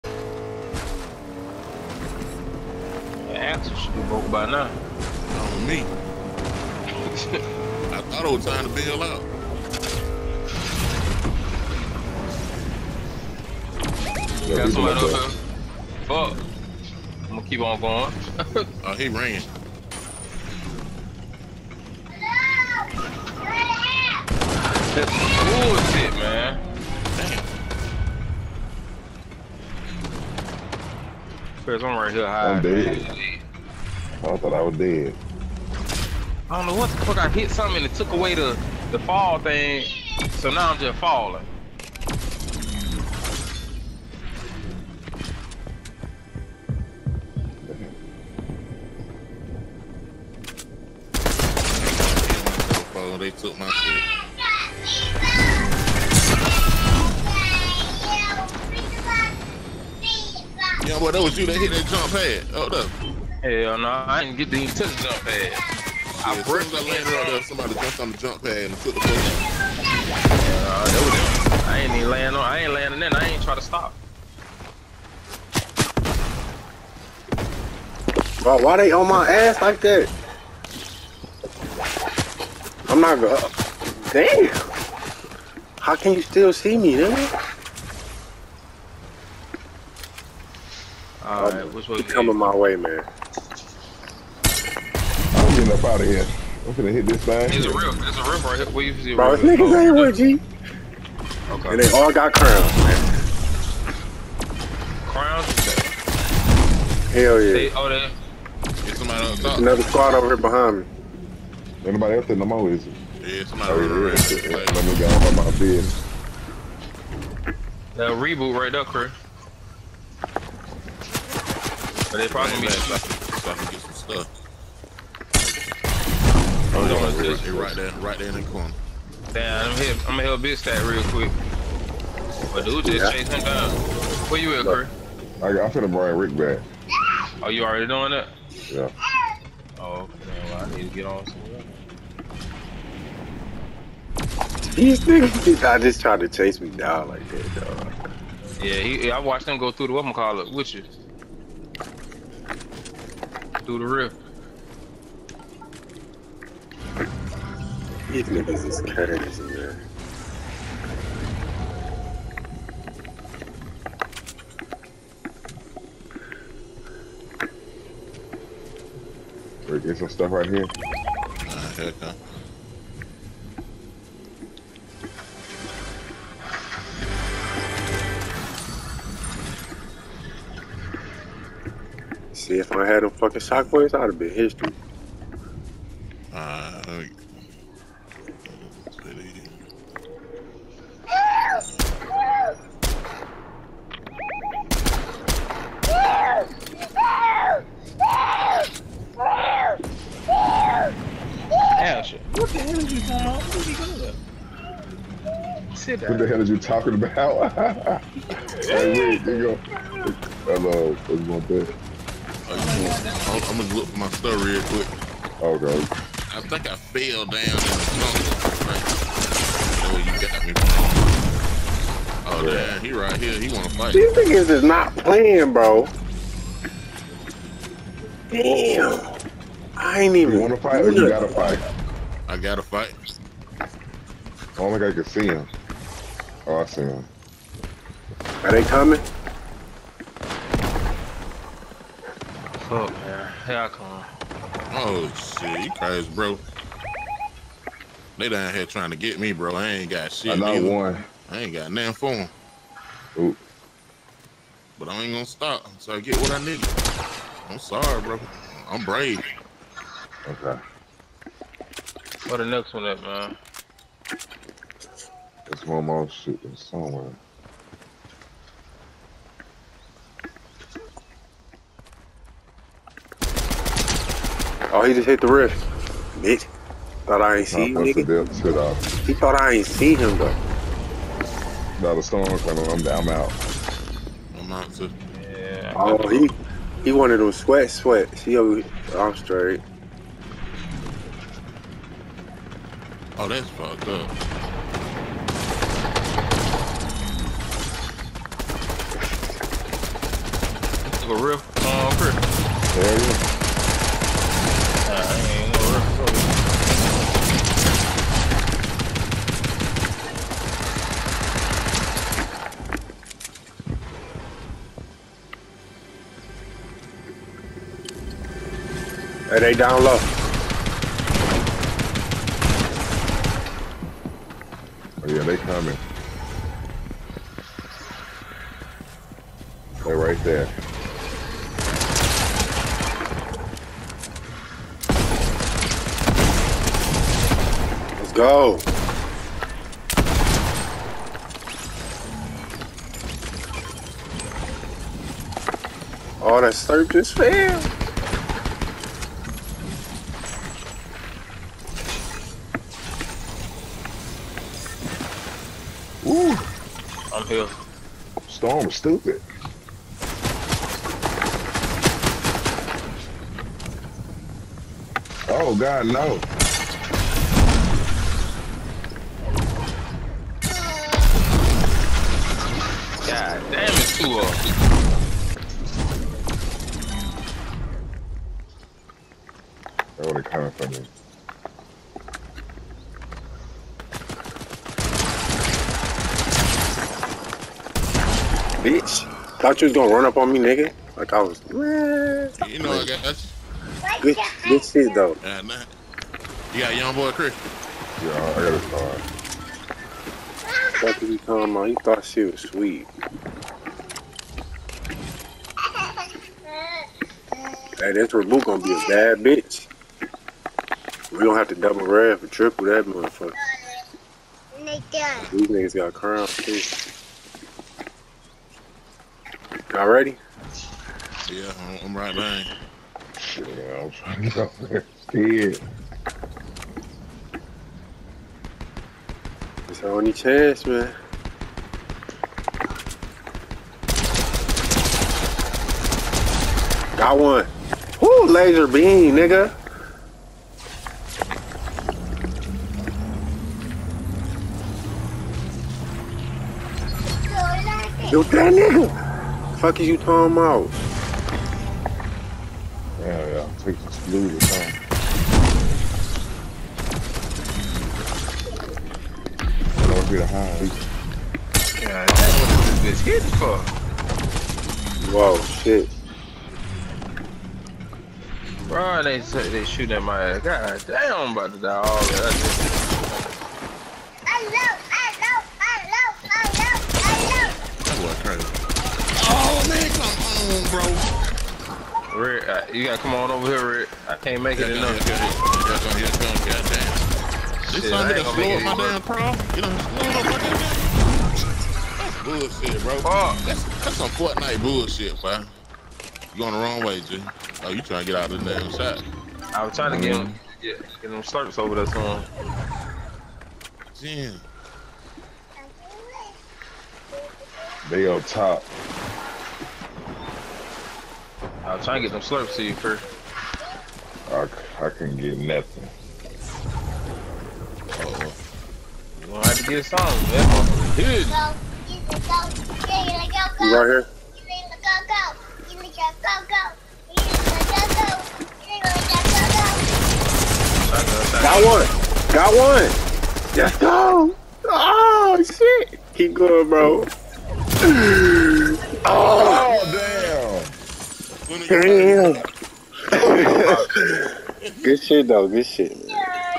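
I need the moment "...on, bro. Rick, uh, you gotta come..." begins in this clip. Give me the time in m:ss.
8:00.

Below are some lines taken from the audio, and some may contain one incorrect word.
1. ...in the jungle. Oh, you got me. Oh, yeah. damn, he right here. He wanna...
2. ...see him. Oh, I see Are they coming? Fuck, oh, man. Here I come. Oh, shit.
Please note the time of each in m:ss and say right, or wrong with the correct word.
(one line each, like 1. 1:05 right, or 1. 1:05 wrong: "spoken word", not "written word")
1. 3:37 right
2. 3:55 right.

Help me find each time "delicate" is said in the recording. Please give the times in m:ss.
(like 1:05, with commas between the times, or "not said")
not said.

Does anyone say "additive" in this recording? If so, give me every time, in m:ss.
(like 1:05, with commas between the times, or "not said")
not said.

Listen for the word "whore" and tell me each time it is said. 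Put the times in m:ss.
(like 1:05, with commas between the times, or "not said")
not said.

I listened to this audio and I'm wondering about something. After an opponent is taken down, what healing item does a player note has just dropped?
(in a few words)
Slurp.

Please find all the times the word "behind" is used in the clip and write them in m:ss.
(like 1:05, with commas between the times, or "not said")
1:50, 7:02.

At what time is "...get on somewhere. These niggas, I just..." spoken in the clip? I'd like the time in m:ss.
2:20.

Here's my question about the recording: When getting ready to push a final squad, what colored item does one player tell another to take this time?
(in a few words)
Blue.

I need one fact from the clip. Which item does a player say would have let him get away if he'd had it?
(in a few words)
Shockwaves.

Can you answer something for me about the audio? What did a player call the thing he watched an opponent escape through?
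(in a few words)
The rip.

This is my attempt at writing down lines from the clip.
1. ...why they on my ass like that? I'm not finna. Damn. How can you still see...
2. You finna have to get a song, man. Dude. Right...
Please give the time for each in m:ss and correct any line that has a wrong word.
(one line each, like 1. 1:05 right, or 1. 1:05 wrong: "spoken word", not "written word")
1. 1:18 wrong: "gonna", not "finna"
2. 8:39 wrong: "gonna", not "finna".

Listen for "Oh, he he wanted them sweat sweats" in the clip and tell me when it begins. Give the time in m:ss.
4:45.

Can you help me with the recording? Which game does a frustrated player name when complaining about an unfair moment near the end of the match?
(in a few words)
Fortnite.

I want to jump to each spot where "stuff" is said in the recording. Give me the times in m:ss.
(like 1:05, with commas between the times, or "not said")
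2:03, 2:50, 3:34.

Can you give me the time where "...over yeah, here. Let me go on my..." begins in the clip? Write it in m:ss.
1:53.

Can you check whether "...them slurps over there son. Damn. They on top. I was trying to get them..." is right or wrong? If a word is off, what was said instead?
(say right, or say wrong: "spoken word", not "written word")
right.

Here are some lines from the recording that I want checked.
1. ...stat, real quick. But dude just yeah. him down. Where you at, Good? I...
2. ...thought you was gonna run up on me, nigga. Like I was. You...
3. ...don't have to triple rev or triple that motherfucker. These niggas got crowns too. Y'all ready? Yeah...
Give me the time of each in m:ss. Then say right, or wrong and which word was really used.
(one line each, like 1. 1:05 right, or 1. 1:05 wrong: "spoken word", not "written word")
1. 2:10 wrong: "Kurt", not "Good"
2. 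6:29 right
3. 6:51 wrong: "double", not "triple".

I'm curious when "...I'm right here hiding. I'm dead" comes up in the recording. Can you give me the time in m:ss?
0:31.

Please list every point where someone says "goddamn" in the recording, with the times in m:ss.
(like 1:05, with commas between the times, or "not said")
8:06.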